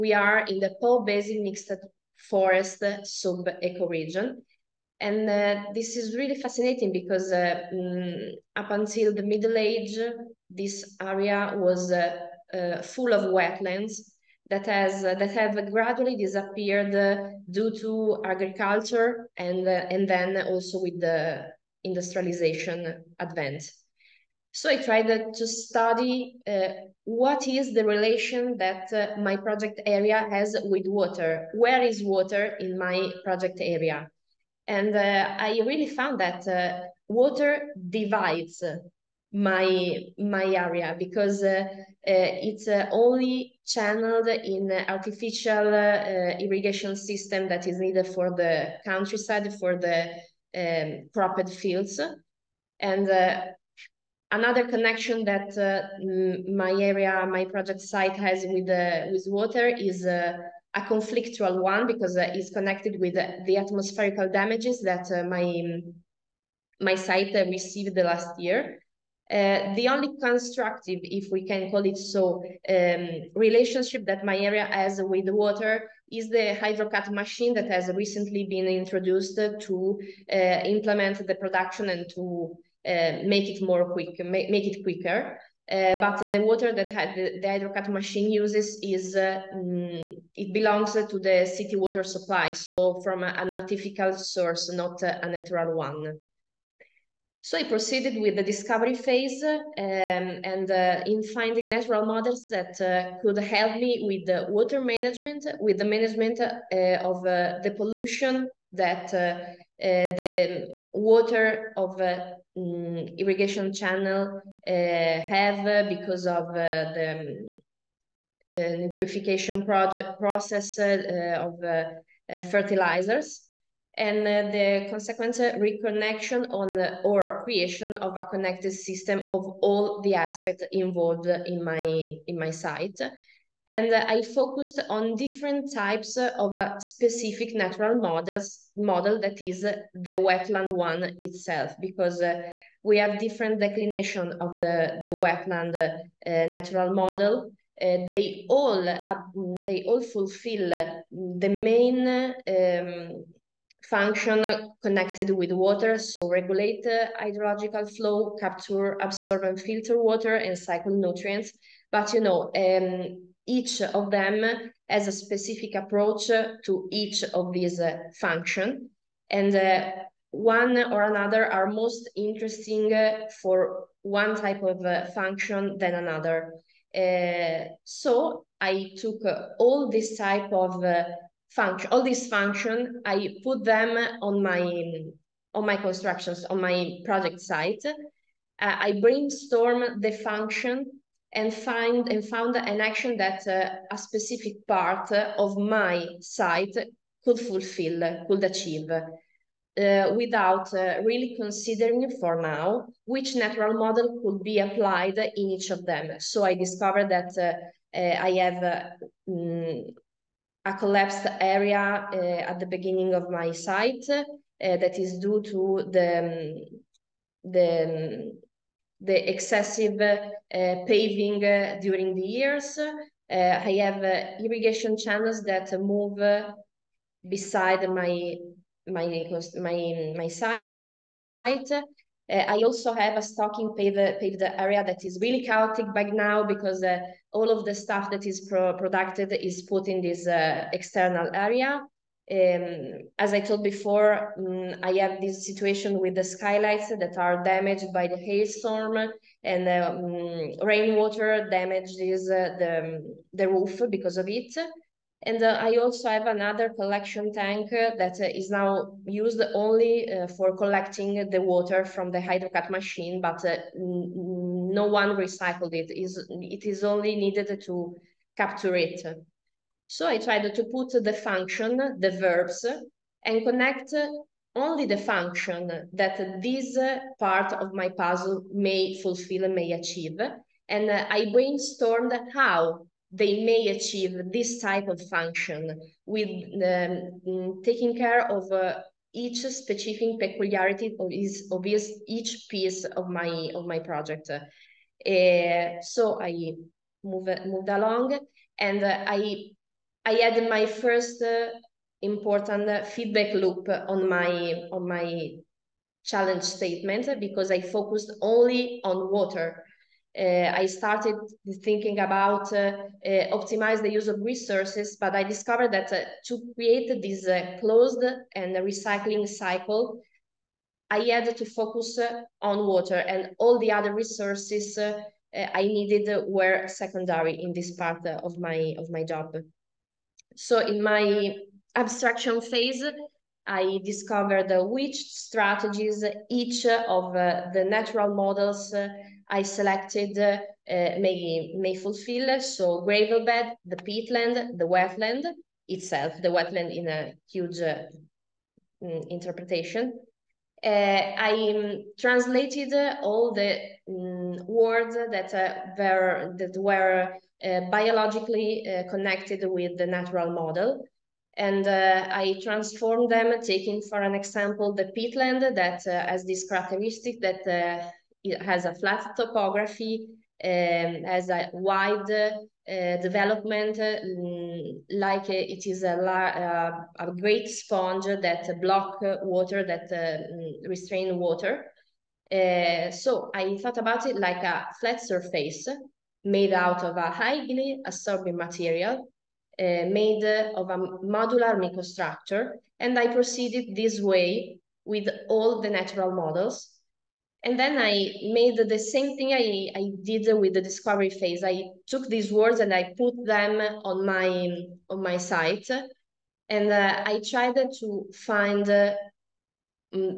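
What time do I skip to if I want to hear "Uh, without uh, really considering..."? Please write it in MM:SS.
03:18.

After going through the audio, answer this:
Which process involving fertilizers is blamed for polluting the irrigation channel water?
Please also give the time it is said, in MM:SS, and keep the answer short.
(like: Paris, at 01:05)
nitrification, at 01:58.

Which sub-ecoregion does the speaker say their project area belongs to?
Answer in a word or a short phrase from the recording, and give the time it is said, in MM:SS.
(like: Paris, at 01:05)
Po Basin Mixed Forest, at 00:00.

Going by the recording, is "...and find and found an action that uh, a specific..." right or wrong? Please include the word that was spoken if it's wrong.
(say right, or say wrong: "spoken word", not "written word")
right.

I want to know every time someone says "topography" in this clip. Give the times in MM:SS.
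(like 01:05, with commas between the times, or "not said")
06:09.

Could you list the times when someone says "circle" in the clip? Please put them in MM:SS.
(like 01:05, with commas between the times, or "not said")
not said.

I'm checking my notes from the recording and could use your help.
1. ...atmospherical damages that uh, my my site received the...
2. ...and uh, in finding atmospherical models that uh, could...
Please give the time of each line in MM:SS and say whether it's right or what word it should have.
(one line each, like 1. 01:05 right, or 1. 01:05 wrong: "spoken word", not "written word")
1. 01:03 right
2. 01:39 wrong: "natural", not "atmospherical".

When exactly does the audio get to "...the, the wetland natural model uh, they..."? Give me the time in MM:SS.
02:24.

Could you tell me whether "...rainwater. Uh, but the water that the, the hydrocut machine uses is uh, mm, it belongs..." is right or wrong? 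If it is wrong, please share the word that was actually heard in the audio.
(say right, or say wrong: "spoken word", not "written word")
wrong: "quicker", not "rainwater".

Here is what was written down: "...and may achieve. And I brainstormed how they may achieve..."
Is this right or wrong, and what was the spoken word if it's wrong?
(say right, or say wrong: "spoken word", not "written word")
right.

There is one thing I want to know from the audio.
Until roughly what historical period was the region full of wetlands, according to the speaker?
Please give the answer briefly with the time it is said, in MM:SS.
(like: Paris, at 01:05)
Middle Age, at 00:09.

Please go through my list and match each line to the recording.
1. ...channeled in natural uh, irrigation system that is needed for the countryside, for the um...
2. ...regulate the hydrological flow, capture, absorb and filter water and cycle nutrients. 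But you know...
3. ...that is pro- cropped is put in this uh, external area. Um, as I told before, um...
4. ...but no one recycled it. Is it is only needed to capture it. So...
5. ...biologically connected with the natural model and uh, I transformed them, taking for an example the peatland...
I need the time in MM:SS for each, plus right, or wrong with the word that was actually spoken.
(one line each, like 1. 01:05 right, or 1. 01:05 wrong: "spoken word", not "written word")
1. 00:43 wrong: "artificial", not "natural"
2. 02:36 right
3. 03:58 wrong: "produced", not "cropped"
4. 04:23 right
5. 05:57 right.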